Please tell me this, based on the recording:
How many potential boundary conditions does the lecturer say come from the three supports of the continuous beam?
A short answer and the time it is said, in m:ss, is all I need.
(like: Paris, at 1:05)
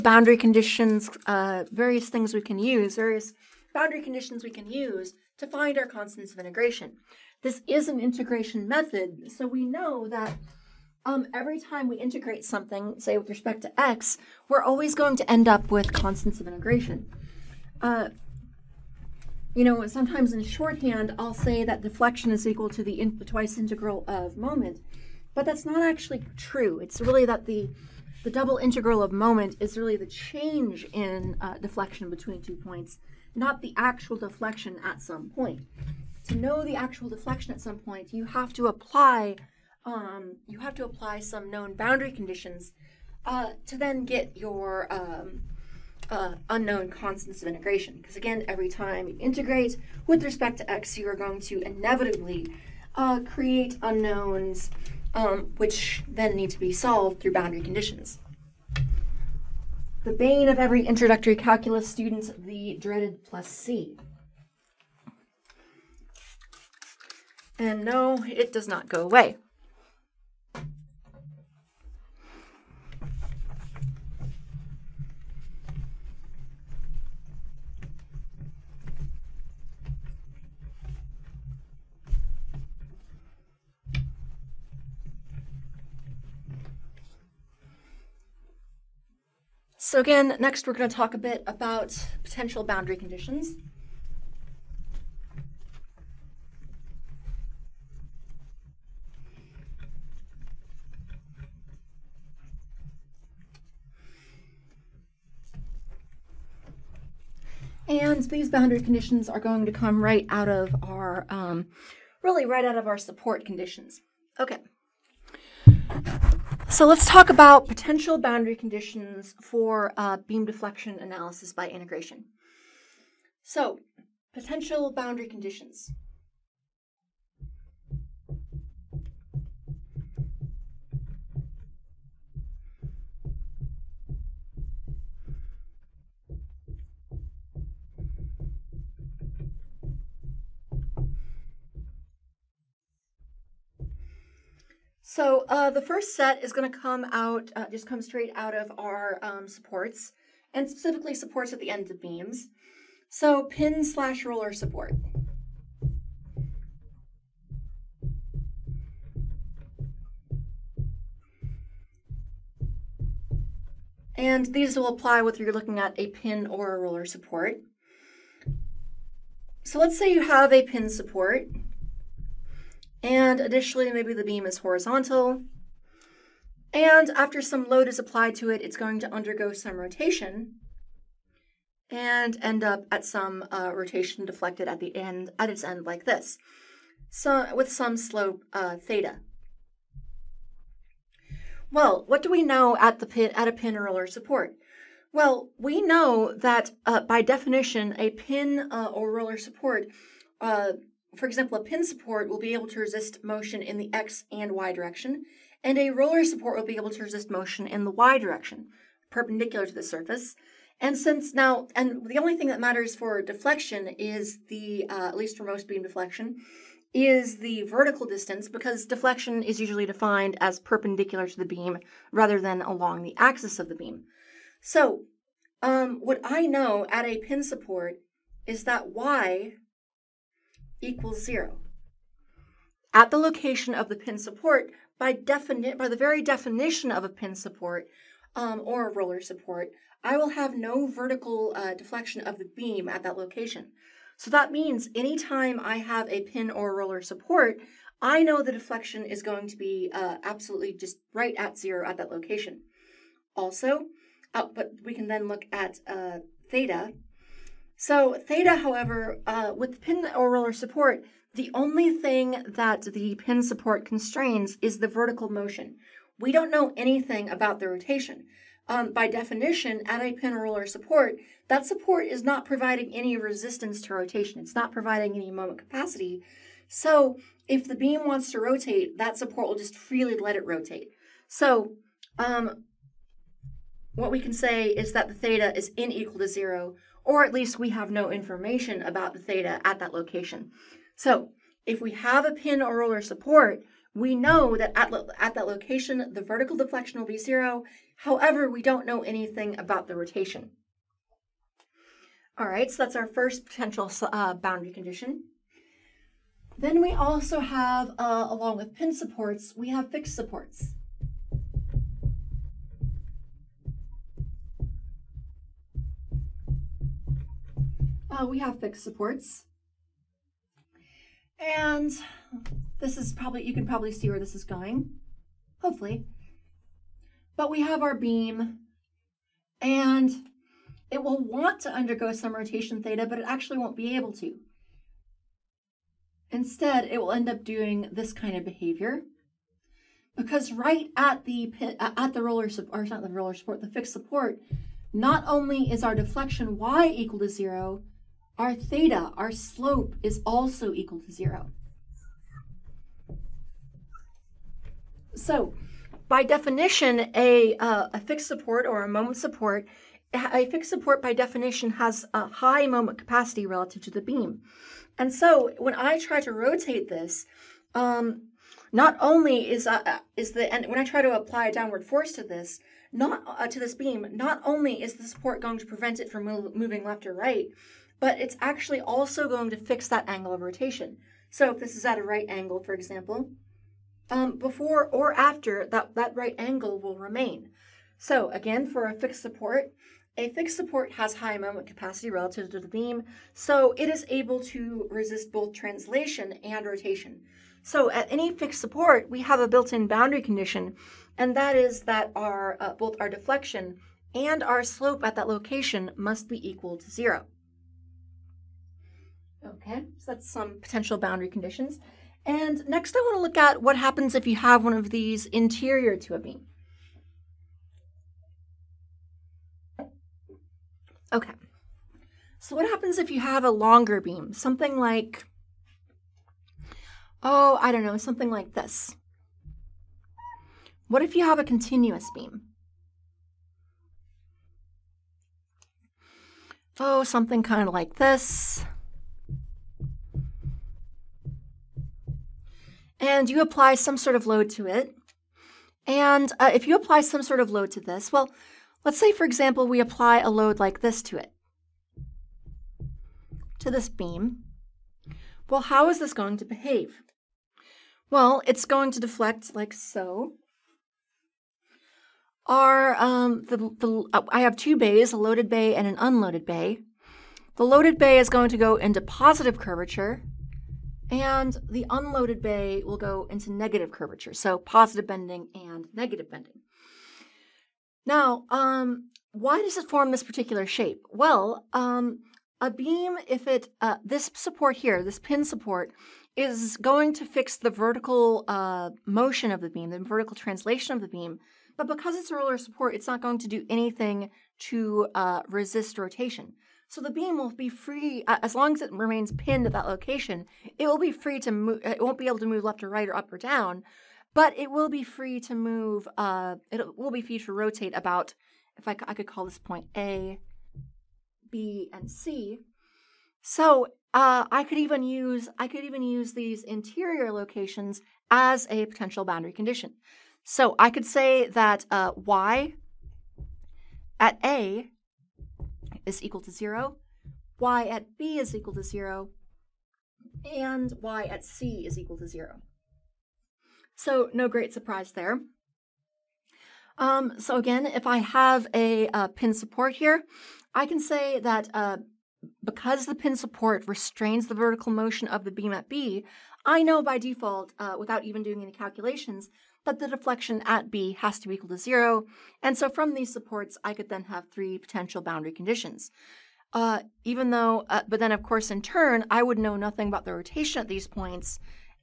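3, at 9:14.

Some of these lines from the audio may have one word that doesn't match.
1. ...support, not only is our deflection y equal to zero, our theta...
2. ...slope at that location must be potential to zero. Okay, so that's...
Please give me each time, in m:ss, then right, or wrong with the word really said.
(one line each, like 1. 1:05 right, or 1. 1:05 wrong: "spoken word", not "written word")
1. 5:43 right
2. 6:44 wrong: "equal", not "potential".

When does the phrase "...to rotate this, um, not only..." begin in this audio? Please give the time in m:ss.
6:06.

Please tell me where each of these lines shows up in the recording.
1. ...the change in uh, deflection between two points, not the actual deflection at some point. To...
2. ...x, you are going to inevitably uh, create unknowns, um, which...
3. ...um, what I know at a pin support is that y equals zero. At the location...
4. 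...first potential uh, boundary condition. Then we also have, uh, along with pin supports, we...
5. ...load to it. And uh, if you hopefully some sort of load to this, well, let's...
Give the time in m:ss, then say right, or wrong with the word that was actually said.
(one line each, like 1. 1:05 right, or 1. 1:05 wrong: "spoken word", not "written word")
1. 0:29 right
2. 0:50 right
3. 3:45 right
4. 5:03 right
5. 7:24 wrong: "apply", not "hopefully".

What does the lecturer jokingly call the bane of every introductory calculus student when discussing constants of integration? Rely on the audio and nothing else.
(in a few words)
The dreaded plus C.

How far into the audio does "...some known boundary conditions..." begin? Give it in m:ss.
0:41.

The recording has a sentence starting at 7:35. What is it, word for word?
Well, how is this going to behave?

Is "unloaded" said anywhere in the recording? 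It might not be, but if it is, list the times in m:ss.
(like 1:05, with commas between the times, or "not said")
7:45, 7:51.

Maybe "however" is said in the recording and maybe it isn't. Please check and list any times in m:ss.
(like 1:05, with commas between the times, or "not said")
4:18, 4:57.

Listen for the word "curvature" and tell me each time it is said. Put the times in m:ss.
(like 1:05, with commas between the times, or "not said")
7:49, 7:53.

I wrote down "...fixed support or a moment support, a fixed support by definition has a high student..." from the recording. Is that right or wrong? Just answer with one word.
wrong.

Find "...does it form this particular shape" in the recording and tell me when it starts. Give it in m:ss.
7:59.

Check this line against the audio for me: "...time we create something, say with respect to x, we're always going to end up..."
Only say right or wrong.
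wrong.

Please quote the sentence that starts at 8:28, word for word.
If I, could call this point A, B, and C.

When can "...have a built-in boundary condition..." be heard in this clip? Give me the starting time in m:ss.
6:39.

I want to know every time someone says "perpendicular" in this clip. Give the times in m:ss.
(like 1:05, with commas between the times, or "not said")
3:29, 3:40.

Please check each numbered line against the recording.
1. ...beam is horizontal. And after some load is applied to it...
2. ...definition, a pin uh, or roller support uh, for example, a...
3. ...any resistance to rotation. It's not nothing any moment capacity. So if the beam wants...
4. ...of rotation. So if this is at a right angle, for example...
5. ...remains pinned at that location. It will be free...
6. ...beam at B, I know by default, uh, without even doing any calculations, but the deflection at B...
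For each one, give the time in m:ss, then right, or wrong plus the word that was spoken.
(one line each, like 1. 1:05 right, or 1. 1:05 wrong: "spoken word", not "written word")
1. 2:54 right
2. 3:17 right
3. 4:32 wrong: "providing", not "nothing"
4. 6:20 right
5. 8:18 right
6. 9:05 right.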